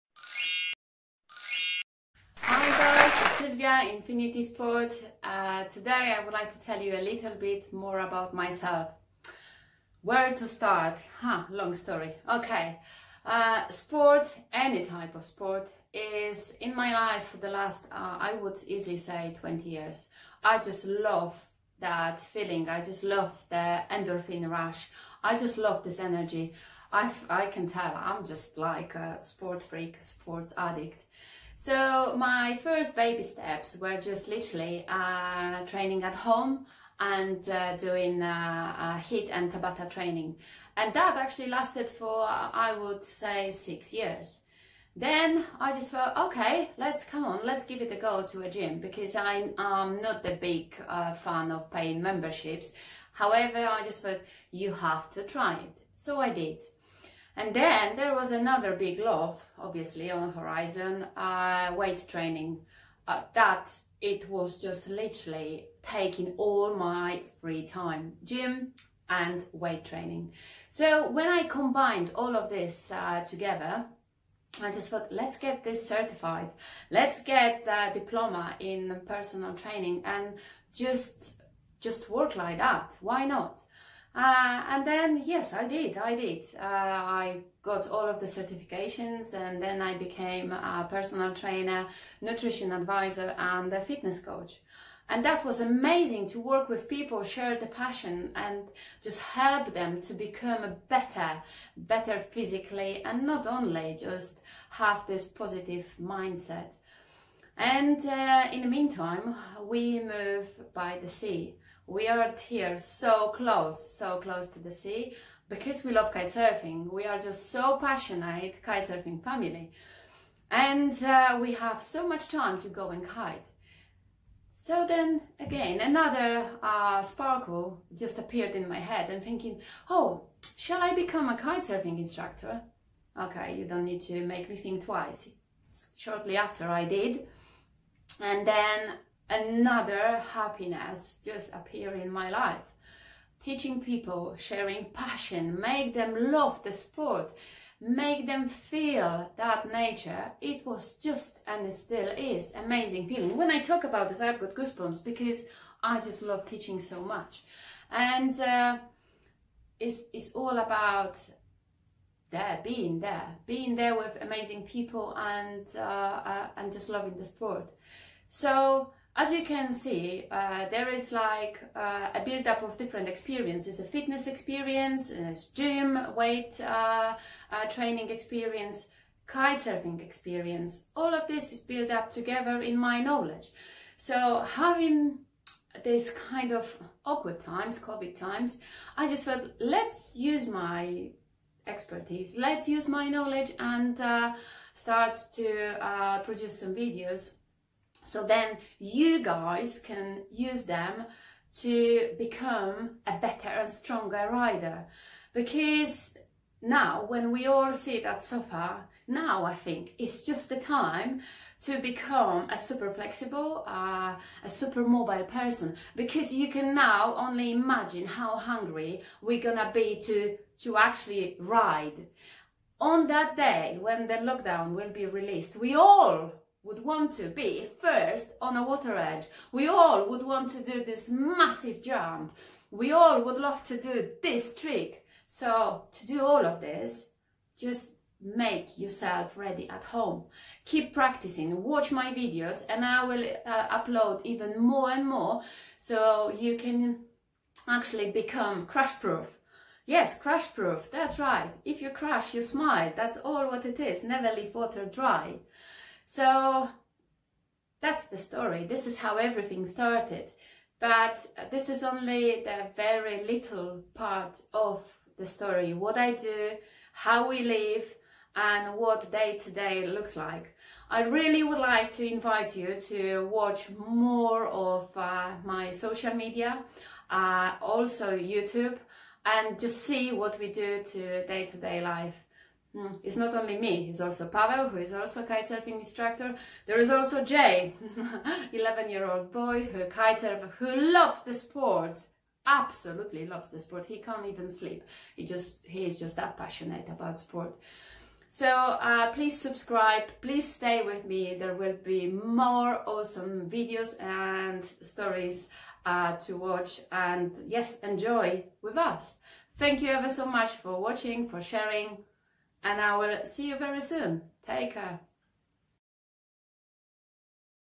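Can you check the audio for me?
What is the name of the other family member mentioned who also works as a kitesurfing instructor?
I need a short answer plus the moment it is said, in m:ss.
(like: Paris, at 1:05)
Pavel, at 4:44.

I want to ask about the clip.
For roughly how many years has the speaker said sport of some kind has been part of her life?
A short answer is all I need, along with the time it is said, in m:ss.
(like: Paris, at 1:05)
20 years, at 0:19.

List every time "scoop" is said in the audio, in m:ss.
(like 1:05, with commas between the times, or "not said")
not said.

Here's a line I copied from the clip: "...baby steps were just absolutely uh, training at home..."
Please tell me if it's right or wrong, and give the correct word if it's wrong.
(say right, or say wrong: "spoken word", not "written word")
wrong: "literally", not "absolutely".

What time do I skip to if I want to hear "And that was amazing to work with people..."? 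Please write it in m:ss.
1:35.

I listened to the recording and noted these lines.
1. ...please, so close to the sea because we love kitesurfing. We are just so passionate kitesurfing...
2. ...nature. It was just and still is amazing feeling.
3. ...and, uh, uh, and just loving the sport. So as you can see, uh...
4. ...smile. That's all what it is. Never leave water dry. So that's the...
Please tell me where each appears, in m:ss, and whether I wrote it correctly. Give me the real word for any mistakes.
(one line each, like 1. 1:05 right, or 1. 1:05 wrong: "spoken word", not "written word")
1. 1:53 wrong: "close", not "please"
2. 2:29 right
3. 2:45 right
4. 4:12 right.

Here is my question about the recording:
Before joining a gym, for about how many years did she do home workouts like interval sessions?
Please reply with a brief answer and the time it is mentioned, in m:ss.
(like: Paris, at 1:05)
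6 years, at 0:43.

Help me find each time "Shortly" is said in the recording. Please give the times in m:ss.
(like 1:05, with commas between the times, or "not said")
2:15.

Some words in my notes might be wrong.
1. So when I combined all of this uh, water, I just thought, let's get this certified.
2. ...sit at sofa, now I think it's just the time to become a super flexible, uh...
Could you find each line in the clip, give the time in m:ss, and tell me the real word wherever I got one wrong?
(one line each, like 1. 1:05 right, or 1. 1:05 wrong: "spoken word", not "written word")
1. 1:10 wrong: "together", not "water"
2. 3:27 right.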